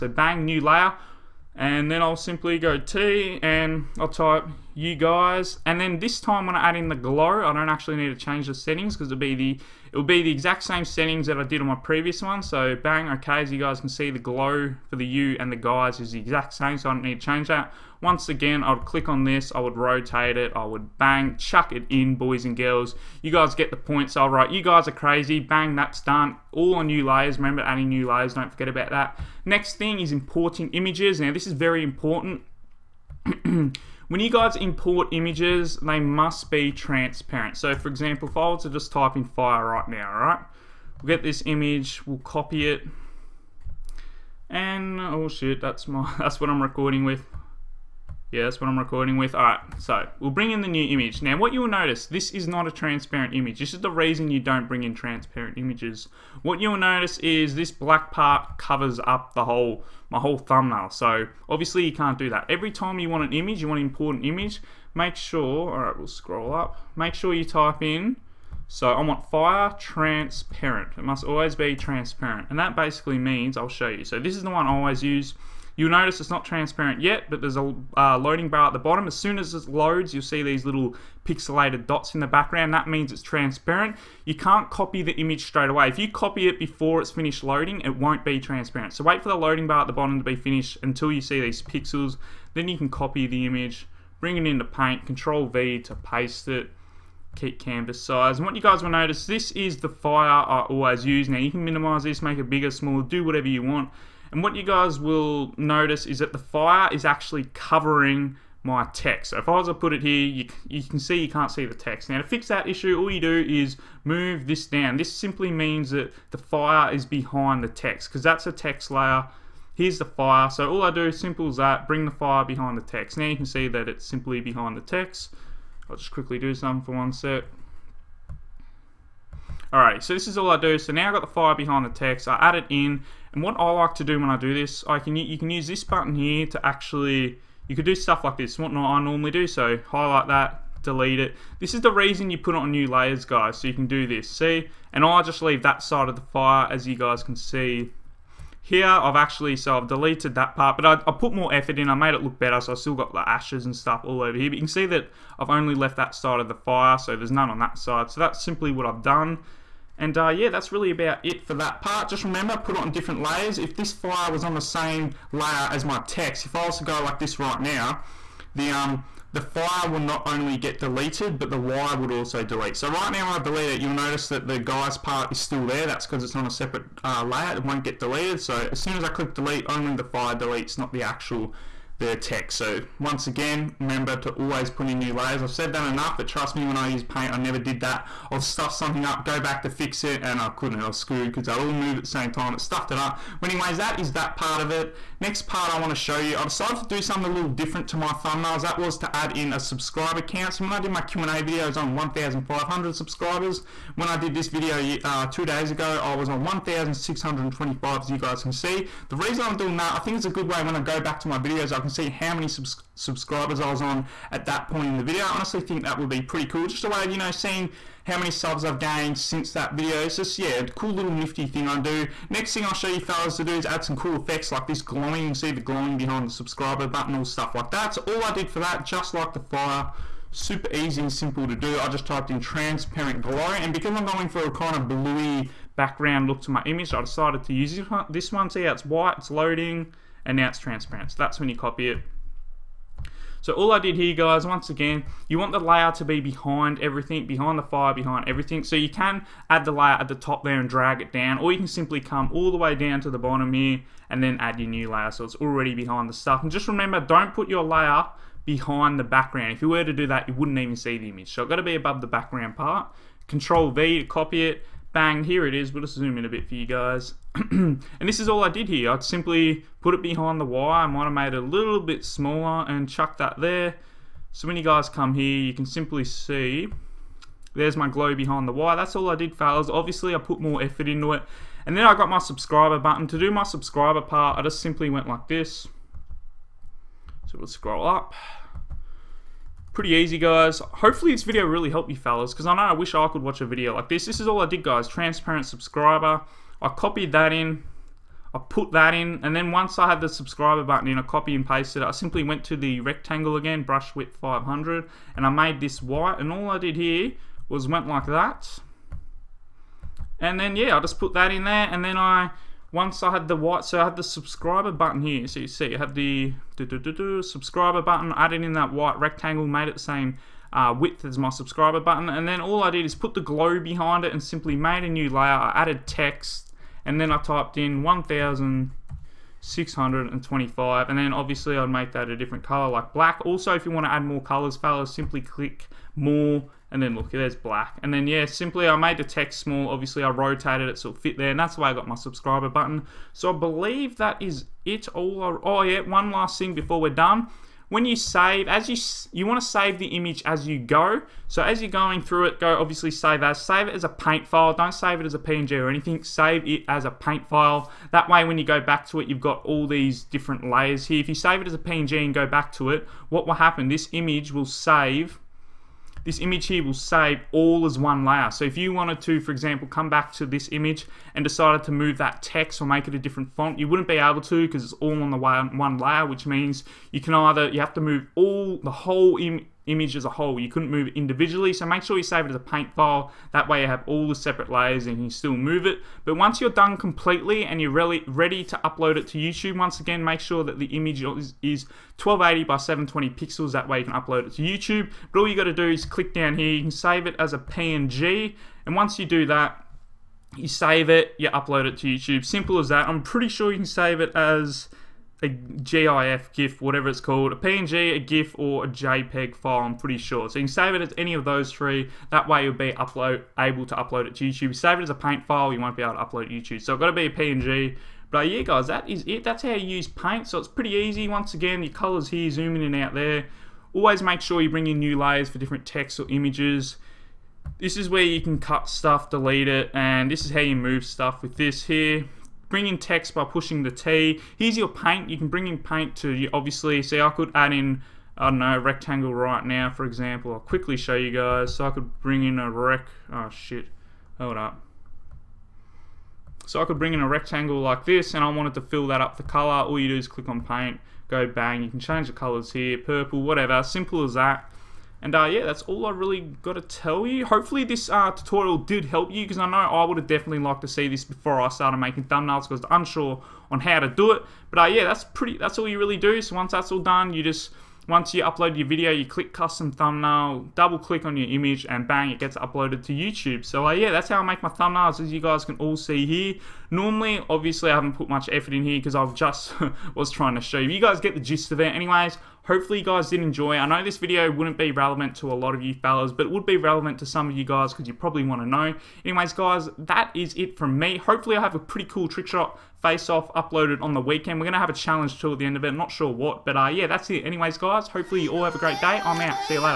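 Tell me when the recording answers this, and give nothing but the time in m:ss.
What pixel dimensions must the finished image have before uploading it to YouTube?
6:32.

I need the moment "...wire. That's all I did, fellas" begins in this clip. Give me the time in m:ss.
4:38.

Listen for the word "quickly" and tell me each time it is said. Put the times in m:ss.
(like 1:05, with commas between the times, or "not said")
2:06, 7:20.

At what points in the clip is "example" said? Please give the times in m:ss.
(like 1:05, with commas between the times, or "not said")
0:37, 6:09, 7:19.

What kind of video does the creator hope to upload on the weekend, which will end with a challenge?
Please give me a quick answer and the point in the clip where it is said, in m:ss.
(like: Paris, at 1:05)
trick shot face off, at 8:12.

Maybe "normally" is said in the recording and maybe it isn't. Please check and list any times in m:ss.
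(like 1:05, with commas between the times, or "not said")
2:19, 7:56.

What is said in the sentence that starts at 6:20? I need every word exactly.
You couldn't move it individually, so make sure you save it as a paint file.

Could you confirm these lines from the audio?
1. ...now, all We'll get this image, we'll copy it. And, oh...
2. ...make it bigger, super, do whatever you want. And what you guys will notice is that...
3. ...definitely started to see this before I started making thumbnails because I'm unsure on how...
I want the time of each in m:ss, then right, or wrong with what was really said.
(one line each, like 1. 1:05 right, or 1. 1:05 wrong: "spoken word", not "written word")
1. 0:39 right
2. 1:42 wrong: "smaller", not "super"
3. 7:40 wrong: "liked", not "started".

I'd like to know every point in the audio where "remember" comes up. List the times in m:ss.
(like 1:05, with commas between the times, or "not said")
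0:27, 2:42, 3:03, 4:16.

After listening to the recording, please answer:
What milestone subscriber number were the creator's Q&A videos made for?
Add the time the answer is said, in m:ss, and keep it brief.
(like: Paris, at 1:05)
1,500, at 3:21.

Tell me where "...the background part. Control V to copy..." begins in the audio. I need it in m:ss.
4:22.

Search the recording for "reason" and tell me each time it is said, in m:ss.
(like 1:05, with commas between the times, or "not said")
0:53, 2:21, 3:29.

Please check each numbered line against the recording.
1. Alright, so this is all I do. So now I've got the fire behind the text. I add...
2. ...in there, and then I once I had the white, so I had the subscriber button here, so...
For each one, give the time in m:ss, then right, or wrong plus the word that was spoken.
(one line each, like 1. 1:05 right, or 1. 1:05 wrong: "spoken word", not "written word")
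1. 2:09 right
2. 5:11 right.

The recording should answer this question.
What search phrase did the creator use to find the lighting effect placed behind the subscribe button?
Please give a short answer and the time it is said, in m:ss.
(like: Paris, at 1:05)
transparent glow, at 3:52.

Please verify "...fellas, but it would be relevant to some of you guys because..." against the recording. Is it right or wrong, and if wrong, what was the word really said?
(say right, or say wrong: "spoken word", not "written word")
right.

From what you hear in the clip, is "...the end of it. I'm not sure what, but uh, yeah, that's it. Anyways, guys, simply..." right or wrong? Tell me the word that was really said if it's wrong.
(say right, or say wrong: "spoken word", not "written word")
wrong: "hopefully", not "simply".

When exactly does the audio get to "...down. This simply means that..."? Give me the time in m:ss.
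1:54.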